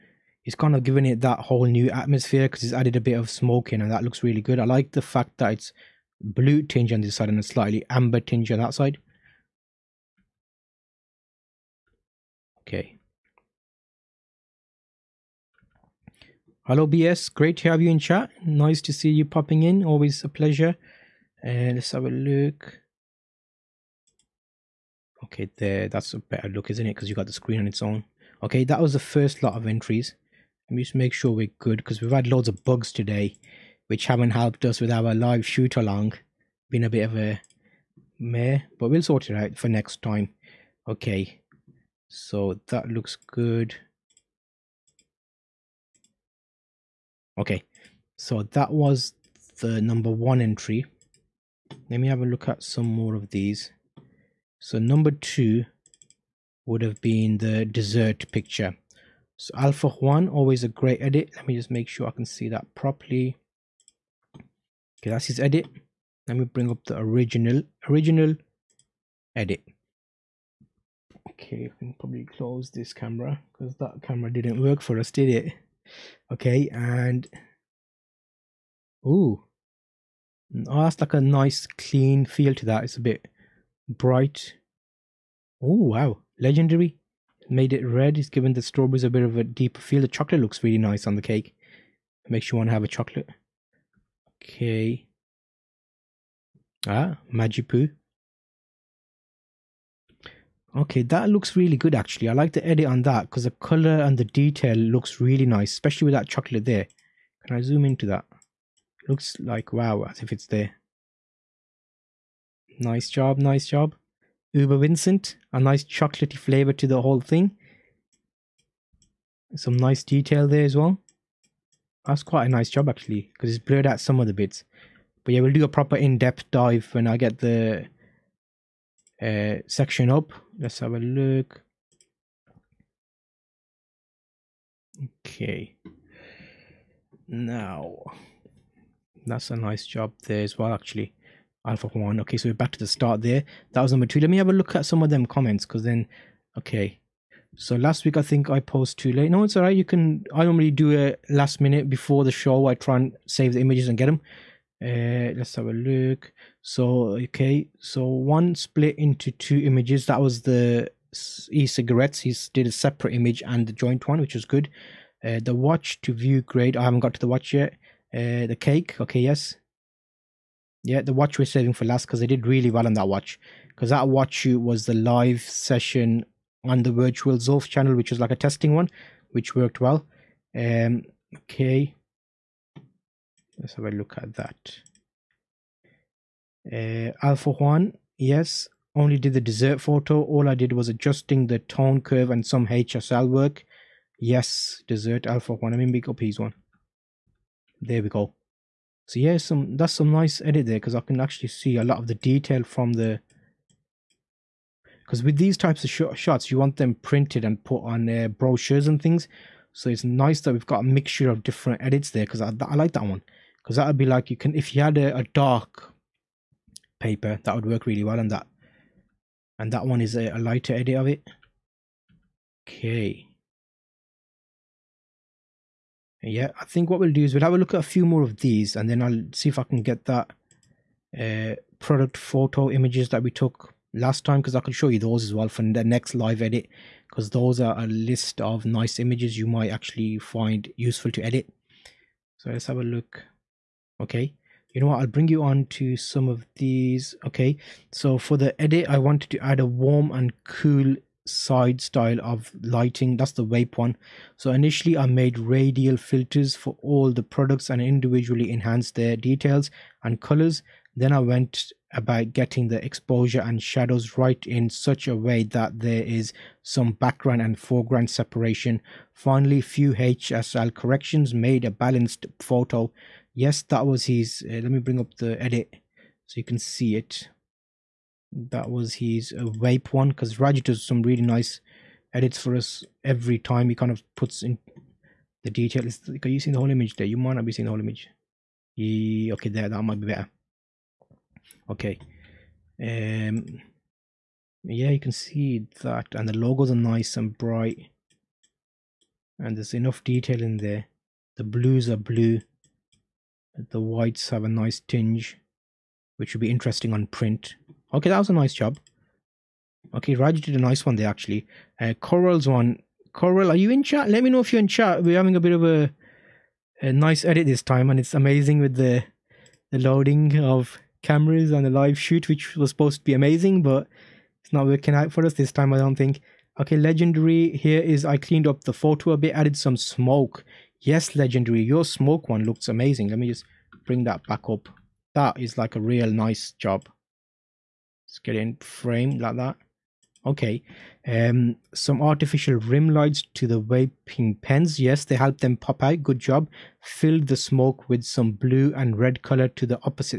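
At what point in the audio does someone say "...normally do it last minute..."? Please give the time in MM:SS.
02:30.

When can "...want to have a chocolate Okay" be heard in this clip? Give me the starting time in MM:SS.
01:32.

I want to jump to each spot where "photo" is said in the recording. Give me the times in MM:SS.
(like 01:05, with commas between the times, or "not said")
03:09, 03:52, 04:32, 05:28.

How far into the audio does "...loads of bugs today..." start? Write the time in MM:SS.
00:32.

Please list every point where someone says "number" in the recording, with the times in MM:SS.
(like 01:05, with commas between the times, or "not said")
00:49, 00:54, 02:23.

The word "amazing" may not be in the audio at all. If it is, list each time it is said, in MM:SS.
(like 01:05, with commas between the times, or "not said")
05:18, 05:23, 05:32.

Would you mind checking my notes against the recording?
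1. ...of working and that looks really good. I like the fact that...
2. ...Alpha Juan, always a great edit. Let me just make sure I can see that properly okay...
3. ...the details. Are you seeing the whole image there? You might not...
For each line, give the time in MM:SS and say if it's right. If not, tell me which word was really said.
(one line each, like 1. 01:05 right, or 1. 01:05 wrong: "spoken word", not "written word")
1. 00:03 wrong: "smoking", not "working"
2. 00:59 right
3. 04:45 right.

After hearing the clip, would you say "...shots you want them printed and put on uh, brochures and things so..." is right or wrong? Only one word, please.
right.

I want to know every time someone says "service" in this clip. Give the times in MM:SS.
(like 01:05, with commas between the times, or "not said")
not said.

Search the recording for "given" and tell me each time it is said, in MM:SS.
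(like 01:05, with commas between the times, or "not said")
01:28.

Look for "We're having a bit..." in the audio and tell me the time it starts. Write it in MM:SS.
05:15.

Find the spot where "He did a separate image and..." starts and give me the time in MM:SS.
02:42.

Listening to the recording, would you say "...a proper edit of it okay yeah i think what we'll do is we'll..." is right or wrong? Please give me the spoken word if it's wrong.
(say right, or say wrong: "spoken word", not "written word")
wrong: "lighter", not "proper".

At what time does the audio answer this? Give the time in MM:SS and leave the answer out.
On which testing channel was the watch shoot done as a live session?
02:56.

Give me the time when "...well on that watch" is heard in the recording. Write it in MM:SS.
02:52.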